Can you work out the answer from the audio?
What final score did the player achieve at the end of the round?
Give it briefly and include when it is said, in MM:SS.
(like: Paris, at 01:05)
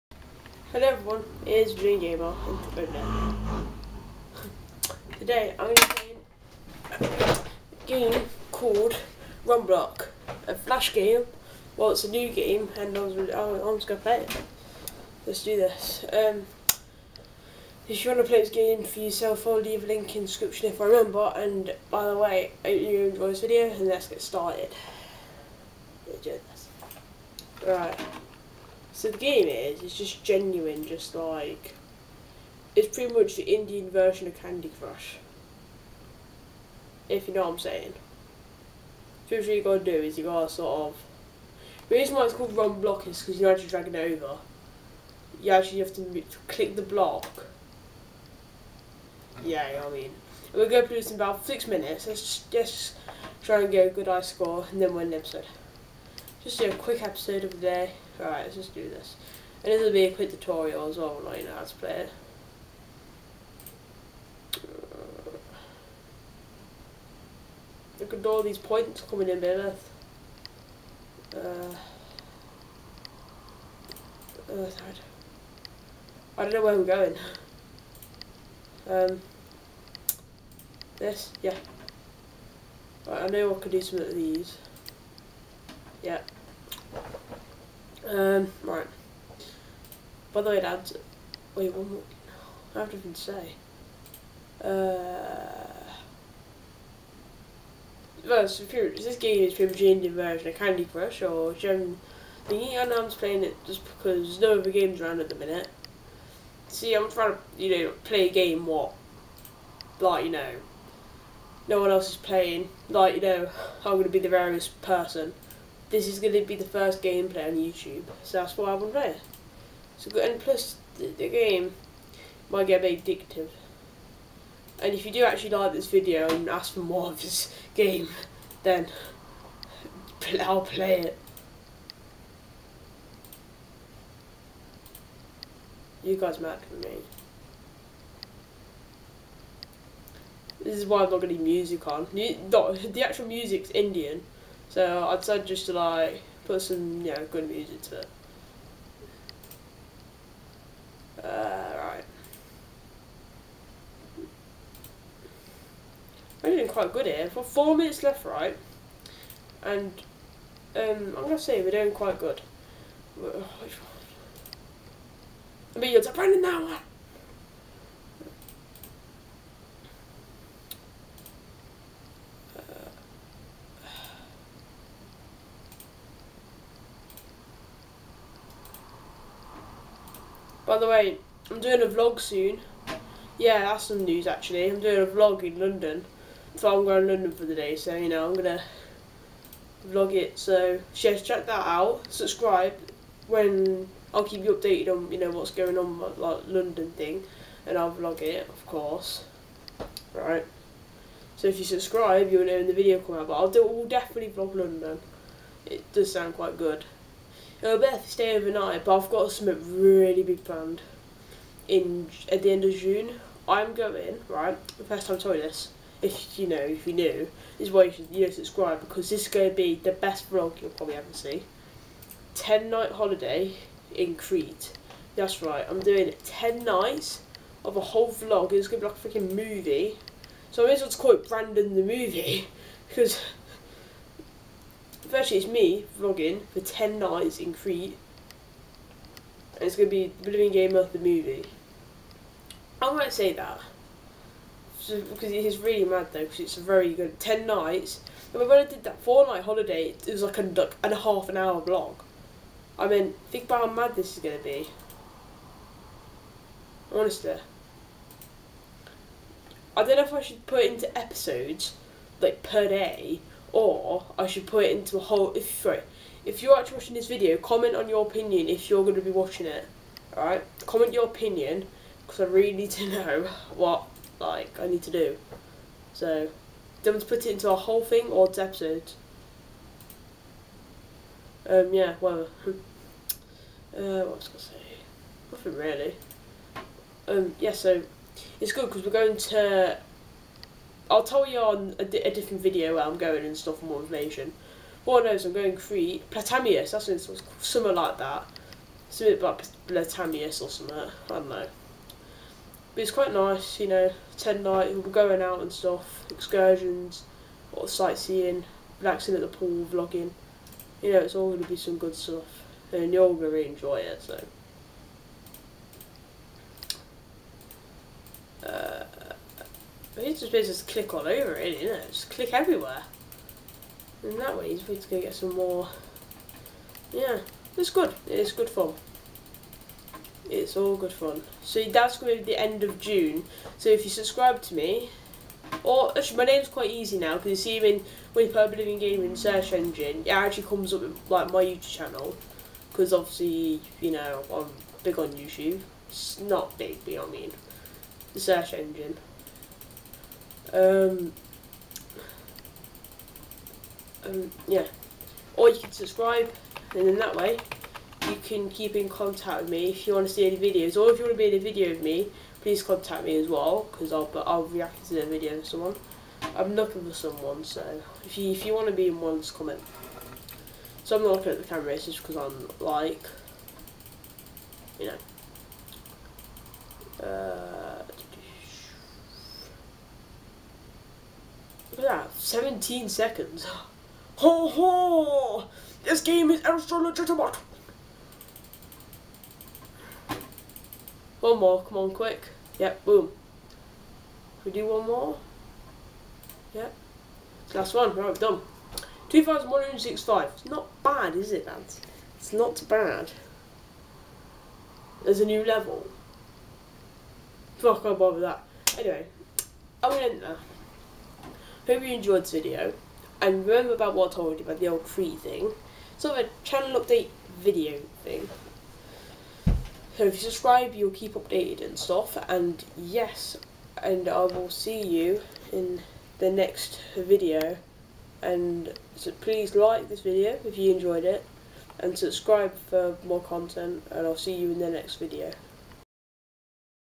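2,165, at 06:39.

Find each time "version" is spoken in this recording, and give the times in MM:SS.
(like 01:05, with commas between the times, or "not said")
00:33, 01:40.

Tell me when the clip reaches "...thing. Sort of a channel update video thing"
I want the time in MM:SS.
06:55.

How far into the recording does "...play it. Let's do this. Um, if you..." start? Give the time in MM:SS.
00:13.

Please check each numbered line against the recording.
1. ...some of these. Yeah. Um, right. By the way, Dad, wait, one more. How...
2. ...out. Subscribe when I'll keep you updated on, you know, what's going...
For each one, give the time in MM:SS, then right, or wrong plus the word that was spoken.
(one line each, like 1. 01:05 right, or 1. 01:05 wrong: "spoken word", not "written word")
1. 01:23 right
2. 03:11 right.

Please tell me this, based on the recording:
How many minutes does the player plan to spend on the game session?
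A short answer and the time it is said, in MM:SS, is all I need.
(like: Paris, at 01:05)
6 minutes, at 00:51.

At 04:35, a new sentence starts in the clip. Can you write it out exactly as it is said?
So, do you want to put it into a whole thing or it's episodes?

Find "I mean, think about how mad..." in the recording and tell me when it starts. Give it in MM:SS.
04:12.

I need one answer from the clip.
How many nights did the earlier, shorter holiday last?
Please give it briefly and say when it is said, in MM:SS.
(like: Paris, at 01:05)
4, at 04:09.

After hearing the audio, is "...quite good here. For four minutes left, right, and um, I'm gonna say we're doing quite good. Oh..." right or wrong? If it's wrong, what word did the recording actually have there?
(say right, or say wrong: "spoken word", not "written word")
right.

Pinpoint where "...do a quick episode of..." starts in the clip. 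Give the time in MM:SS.
00:56.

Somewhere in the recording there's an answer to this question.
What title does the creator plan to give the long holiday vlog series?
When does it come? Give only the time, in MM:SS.
03:51.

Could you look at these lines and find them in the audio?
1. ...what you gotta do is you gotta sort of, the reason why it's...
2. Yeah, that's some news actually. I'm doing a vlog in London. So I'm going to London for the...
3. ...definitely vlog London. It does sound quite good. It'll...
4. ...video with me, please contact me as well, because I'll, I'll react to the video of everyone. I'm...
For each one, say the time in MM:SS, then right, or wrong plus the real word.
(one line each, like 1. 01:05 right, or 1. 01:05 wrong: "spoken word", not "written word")
1. 00:39 right
2. 03:03 right
3. 03:23 right
4. 06:01 wrong: "someone", not "everyone".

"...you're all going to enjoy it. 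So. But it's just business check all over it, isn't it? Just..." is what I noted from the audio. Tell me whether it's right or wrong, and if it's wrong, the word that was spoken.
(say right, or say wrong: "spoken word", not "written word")
wrong: "click", not "check".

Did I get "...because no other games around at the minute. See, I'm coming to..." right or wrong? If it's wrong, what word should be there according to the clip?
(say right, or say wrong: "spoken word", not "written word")
wrong: "trying", not "coming".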